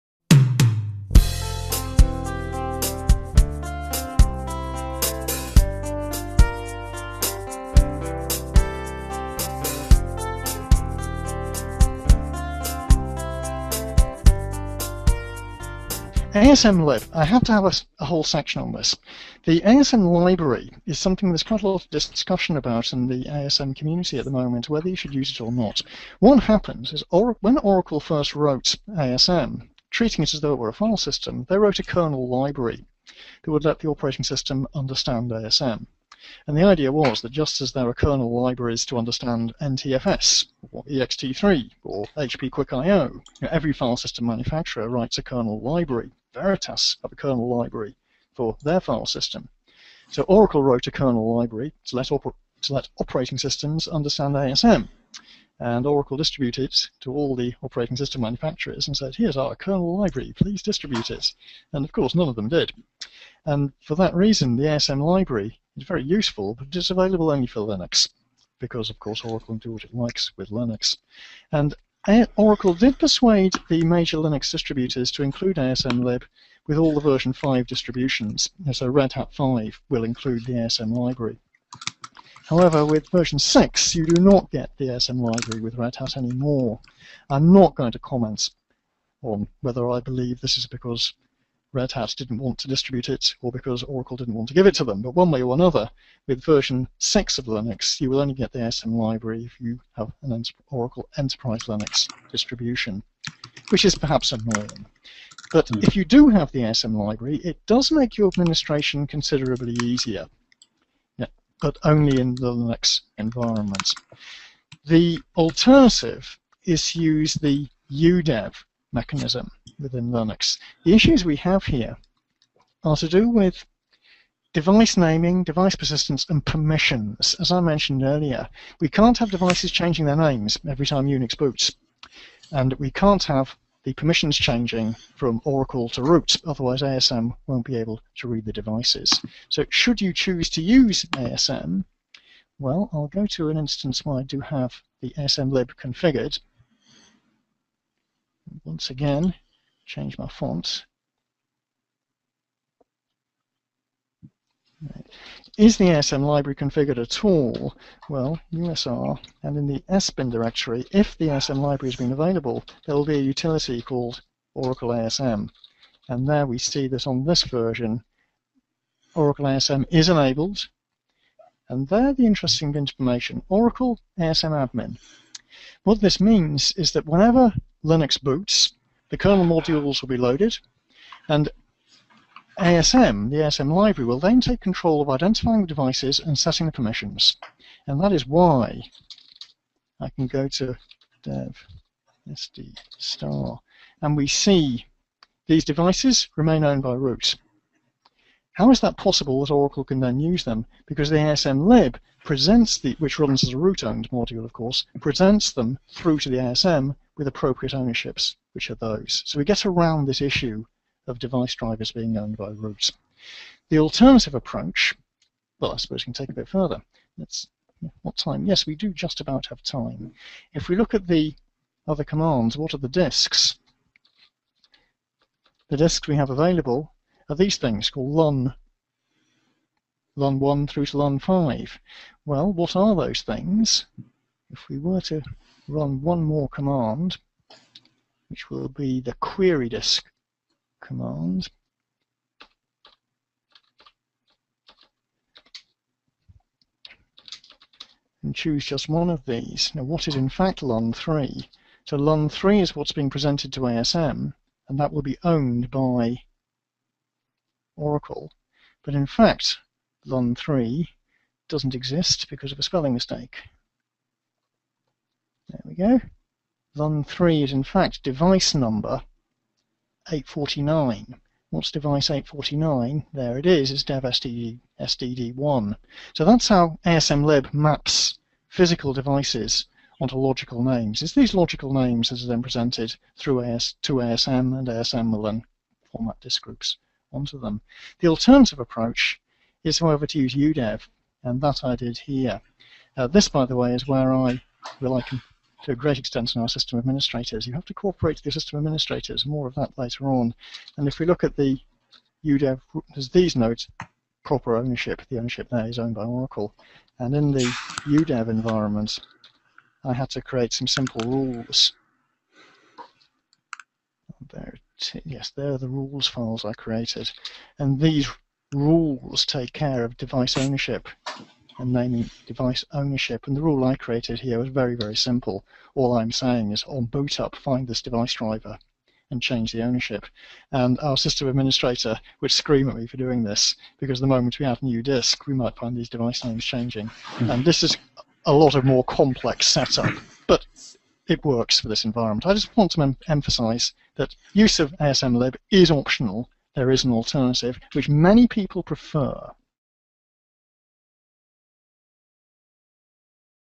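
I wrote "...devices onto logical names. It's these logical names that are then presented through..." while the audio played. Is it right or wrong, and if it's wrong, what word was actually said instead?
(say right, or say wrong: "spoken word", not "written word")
right.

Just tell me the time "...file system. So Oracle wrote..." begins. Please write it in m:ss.
0:48.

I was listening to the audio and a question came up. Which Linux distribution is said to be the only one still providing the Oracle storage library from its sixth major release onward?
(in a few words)
Oracle Enterprise Linux.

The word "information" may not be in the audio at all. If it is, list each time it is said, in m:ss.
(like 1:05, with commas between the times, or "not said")
2:52.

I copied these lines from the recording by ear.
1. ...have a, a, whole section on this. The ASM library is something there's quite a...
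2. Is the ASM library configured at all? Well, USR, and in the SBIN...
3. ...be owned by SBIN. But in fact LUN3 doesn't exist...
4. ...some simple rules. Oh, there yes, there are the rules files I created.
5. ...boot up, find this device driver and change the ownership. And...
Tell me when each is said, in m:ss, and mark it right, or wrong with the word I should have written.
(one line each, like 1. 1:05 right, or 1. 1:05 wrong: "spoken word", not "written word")
1. 0:17 right
2. 2:35 right
3. 4:15 wrong: "Oracle", not "SBIN"
4. 5:10 right
5. 5:26 right.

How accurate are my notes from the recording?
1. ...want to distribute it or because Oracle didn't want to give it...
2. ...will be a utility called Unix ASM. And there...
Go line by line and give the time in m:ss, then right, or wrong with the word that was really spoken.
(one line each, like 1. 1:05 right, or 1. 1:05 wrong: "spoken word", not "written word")
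1. 1:32 right
2. 2:42 wrong: "Oracle", not "Unix".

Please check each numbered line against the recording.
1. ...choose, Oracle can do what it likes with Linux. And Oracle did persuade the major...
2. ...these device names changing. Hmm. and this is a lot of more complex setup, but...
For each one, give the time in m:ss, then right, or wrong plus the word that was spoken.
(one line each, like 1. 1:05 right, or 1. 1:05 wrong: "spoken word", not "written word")
1. 1:08 wrong: "course", not "choose"
2. 5:35 right.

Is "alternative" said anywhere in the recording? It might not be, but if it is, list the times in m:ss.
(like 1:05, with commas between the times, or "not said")
1:55, 3:33, 4:48, 5:46.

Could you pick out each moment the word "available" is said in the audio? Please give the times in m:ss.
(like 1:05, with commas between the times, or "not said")
1:06, 2:42, 3:46.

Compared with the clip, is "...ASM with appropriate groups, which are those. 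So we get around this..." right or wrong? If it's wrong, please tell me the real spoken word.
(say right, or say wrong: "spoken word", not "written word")
wrong: "ownerships", not "groups".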